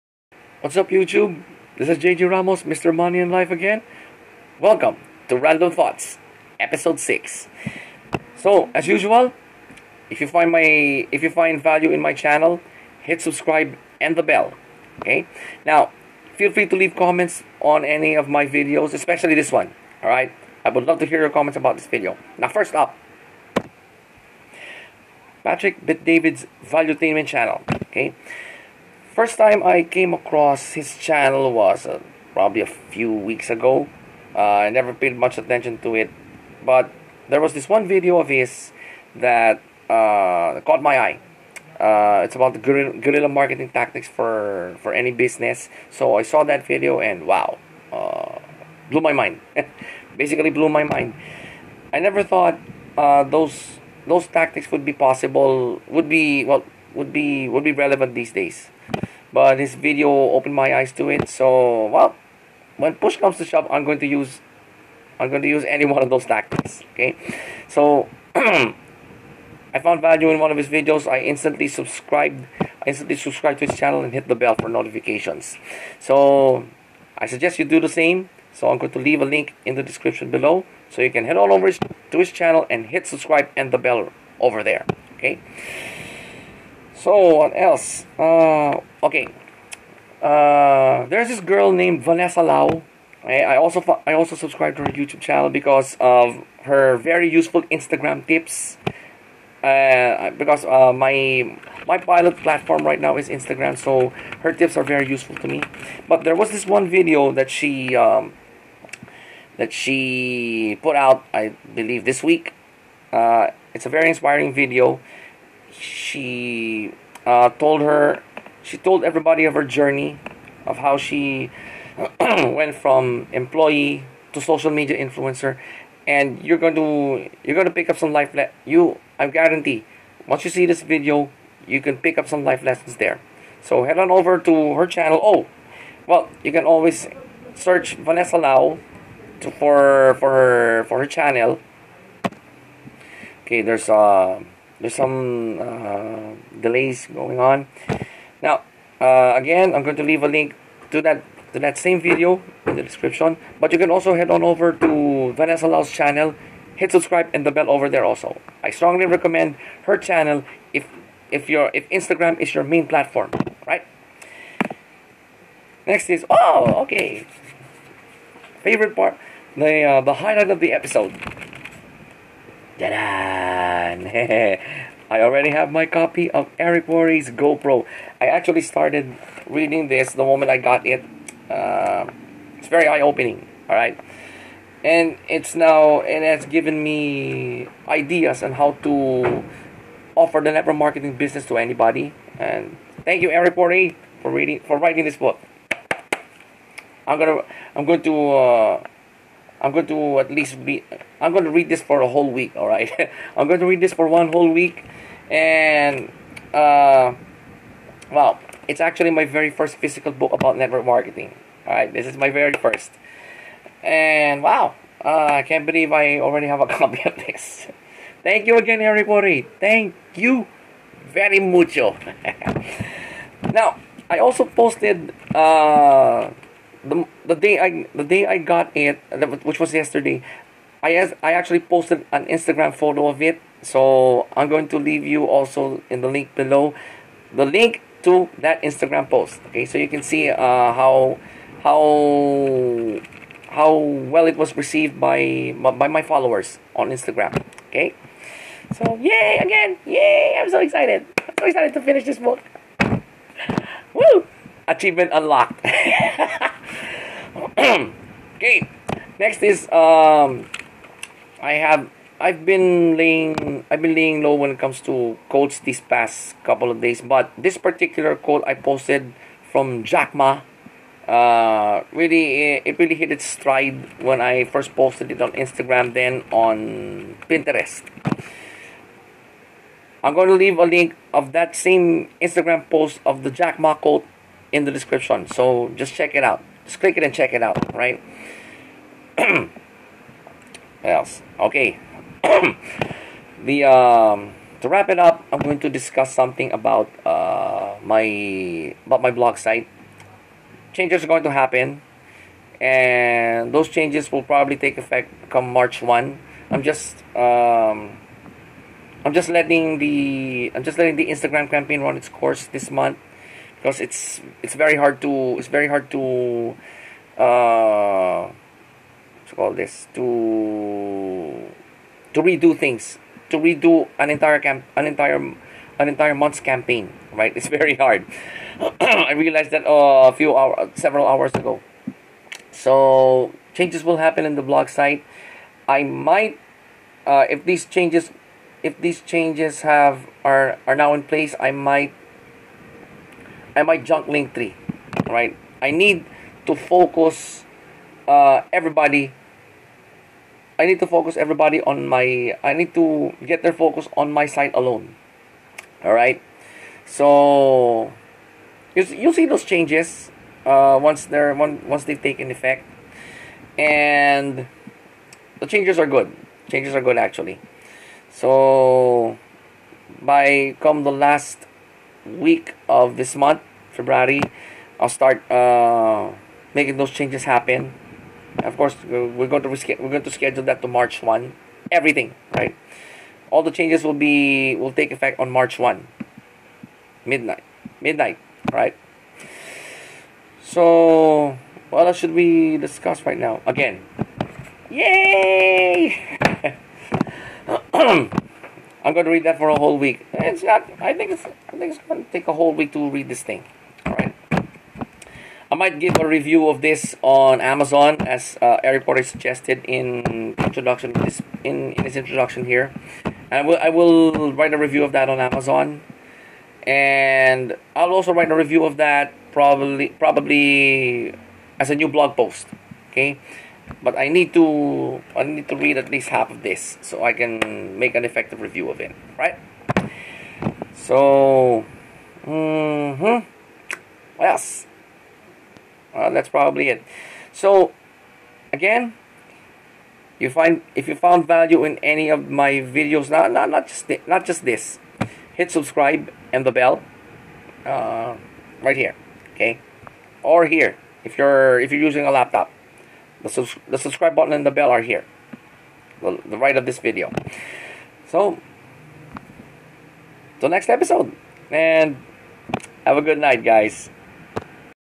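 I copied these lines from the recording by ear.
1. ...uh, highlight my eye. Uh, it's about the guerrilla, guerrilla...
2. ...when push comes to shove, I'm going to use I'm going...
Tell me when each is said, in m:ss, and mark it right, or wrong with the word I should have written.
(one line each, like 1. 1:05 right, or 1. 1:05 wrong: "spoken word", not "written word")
1. 0:39 wrong: "caught", not "highlight"
2. 1:02 right.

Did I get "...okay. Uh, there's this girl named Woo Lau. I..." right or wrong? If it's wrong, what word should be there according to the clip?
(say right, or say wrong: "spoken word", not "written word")
wrong: "Vanessa", not "Woo".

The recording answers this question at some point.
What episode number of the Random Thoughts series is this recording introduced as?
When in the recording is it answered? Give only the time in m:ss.
0:06.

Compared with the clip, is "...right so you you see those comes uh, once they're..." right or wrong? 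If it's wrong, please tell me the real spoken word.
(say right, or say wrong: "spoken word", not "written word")
wrong: "changes", not "comes".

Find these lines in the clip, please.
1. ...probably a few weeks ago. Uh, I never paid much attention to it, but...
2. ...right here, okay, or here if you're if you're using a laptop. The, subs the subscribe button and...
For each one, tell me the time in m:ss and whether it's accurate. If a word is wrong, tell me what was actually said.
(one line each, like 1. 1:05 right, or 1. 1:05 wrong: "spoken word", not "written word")
1. 0:32 right
2. 7:28 right.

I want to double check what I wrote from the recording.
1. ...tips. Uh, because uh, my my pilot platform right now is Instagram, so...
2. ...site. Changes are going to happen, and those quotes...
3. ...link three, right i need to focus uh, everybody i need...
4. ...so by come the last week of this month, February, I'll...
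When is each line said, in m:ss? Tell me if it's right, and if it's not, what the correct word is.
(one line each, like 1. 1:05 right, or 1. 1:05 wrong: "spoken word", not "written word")
1. 1:38 right
2. 4:59 wrong: "changes", not "quotes"
3. 5:44 right
4. 6:08 right.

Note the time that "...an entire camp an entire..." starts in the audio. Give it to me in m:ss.
5:24.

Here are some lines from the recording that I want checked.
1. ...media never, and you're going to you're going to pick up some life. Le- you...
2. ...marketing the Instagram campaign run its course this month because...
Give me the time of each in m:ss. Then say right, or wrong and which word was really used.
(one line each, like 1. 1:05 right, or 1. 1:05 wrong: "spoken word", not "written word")
1. 2:04 wrong: "influencer", not "never"
2. 5:10 wrong: "letting", not "marketing".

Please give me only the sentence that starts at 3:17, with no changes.
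I'm gonna, I'm going to uh, I'm going to at least read.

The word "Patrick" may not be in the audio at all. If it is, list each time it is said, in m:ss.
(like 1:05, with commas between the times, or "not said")
0:25.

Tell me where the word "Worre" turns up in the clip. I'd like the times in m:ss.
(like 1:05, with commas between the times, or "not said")
2:56, 3:13, 6:48.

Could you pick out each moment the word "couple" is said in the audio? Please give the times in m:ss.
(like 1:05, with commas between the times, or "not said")
4:26.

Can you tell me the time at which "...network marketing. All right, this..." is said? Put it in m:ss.
3:30.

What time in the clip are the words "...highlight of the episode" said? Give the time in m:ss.
2:50.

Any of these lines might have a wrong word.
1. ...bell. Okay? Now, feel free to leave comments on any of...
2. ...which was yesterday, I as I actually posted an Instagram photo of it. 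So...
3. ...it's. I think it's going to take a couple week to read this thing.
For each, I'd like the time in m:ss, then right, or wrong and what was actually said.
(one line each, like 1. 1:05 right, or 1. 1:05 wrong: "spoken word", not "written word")
1. 0:14 right
2. 3:49 right
3. 6:41 wrong: "whole", not "couple".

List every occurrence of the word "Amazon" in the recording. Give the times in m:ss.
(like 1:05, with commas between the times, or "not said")
6:47, 6:55.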